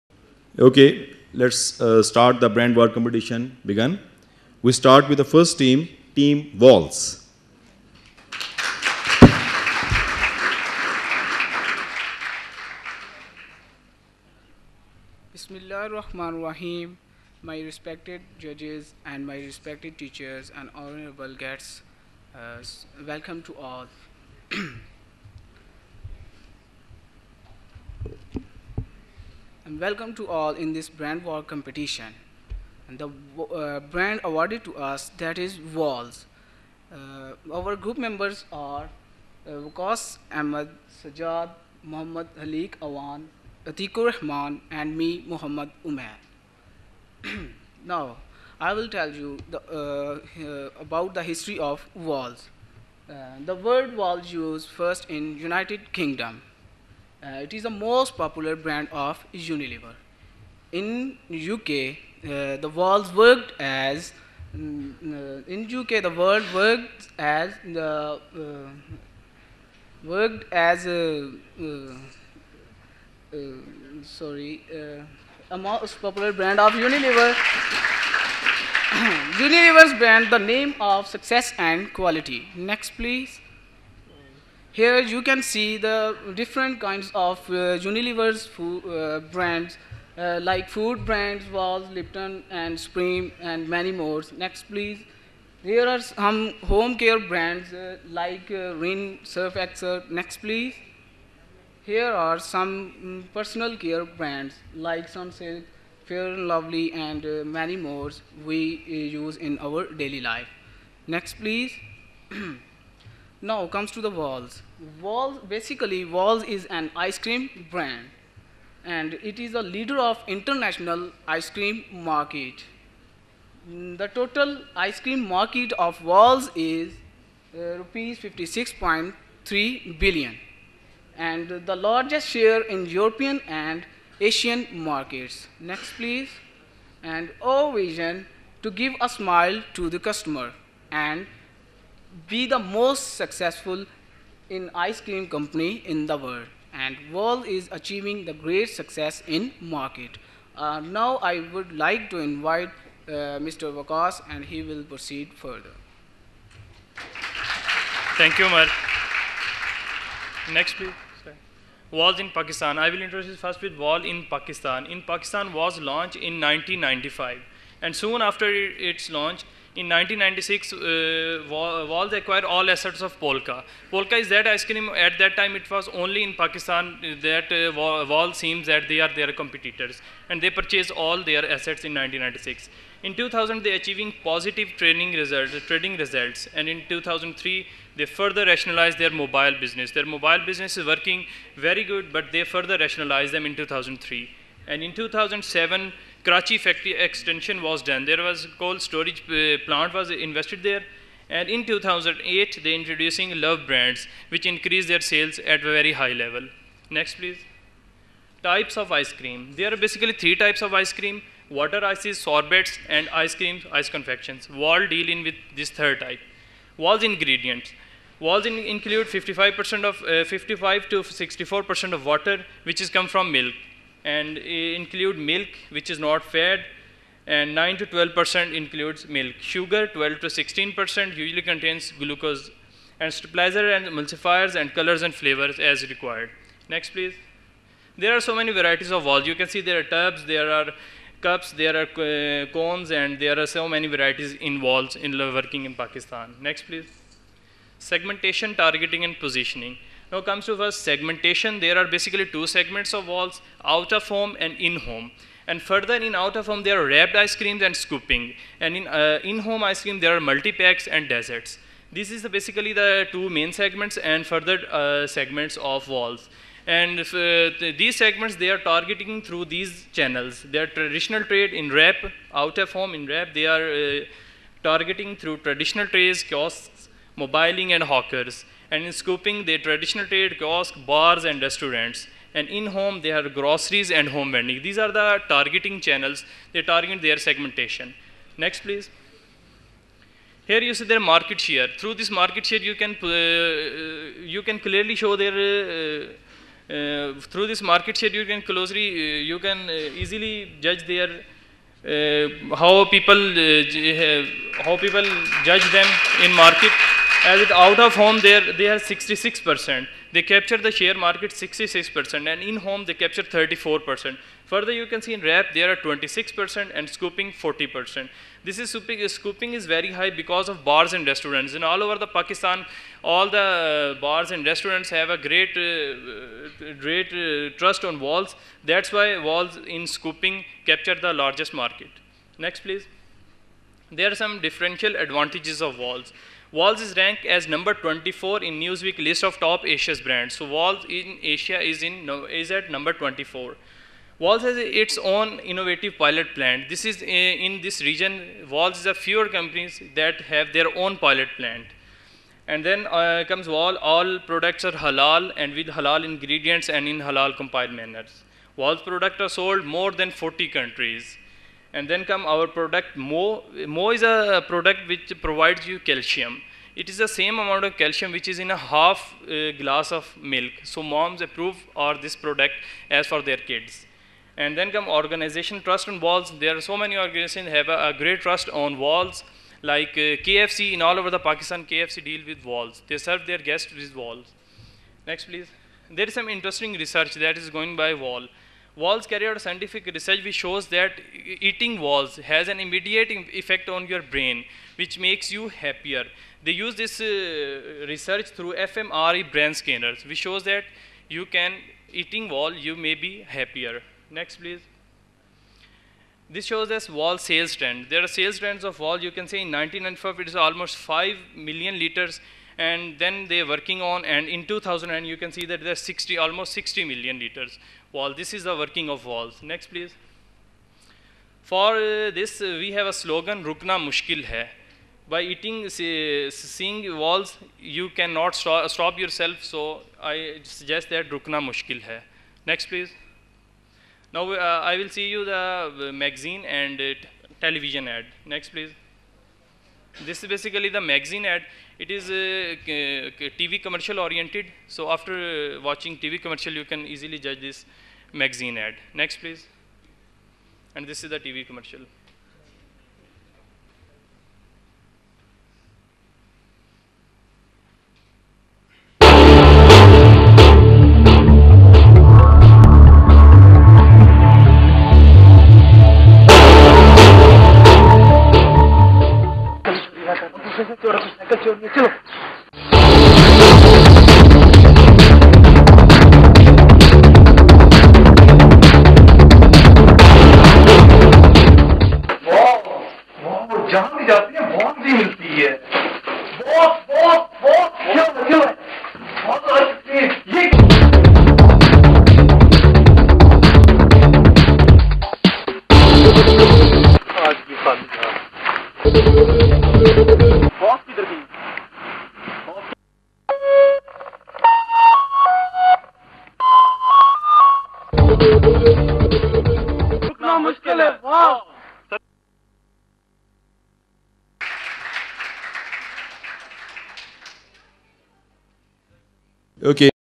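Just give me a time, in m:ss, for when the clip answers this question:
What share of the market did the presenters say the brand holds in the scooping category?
5:16.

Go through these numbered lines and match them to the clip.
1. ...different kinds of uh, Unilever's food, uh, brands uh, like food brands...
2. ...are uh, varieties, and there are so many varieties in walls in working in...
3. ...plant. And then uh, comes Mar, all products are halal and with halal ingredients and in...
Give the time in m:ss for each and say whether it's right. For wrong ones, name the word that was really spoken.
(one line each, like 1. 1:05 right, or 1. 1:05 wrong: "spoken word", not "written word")
1. 1:26 right
2. 4:01 wrong: "cones", not "varieties"
3. 5:51 wrong: "Wall", not "Mar".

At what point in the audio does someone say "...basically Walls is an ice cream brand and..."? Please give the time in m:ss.
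1:55.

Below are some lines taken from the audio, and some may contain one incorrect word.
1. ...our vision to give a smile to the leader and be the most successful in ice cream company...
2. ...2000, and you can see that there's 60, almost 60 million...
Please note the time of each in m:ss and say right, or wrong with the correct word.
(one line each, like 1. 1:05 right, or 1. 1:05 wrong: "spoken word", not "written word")
1. 2:17 wrong: "customer", not "leader"
2. 6:54 right.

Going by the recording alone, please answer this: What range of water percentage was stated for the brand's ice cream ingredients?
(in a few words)
55 to 64%.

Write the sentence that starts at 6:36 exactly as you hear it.
They use this uh, research through fMRI brain scanners, which shows that you can eating wall, you may be happier.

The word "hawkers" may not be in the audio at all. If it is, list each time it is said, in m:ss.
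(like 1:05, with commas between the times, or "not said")
4:37.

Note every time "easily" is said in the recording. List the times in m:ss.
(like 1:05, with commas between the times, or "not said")
5:00, 7:26.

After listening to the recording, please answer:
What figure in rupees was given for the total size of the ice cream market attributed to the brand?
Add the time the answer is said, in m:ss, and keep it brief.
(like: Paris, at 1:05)
56.3 billion, at 2:07.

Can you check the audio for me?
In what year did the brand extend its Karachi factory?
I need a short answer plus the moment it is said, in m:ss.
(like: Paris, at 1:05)
2007, at 3:14.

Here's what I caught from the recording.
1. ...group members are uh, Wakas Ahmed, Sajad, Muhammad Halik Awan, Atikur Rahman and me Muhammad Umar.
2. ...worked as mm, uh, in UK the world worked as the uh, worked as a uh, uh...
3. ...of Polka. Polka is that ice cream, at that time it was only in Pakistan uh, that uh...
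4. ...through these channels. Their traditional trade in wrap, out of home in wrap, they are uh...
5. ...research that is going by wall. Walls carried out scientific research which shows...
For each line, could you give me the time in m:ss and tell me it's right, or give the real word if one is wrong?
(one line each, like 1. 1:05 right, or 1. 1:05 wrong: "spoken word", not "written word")
1. 0:37 right
2. 1:03 right
3. 2:53 right
4. 4:29 right
5. 6:26 right.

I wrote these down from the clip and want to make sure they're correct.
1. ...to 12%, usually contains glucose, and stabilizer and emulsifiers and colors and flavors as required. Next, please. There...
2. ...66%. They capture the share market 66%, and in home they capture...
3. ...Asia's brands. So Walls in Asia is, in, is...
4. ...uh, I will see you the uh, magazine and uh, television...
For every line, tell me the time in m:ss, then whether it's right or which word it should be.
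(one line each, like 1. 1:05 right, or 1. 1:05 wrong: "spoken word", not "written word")
1. 3:50 wrong: "16", not "12"
2. 5:08 right
3. 5:39 right
4. 7:14 right.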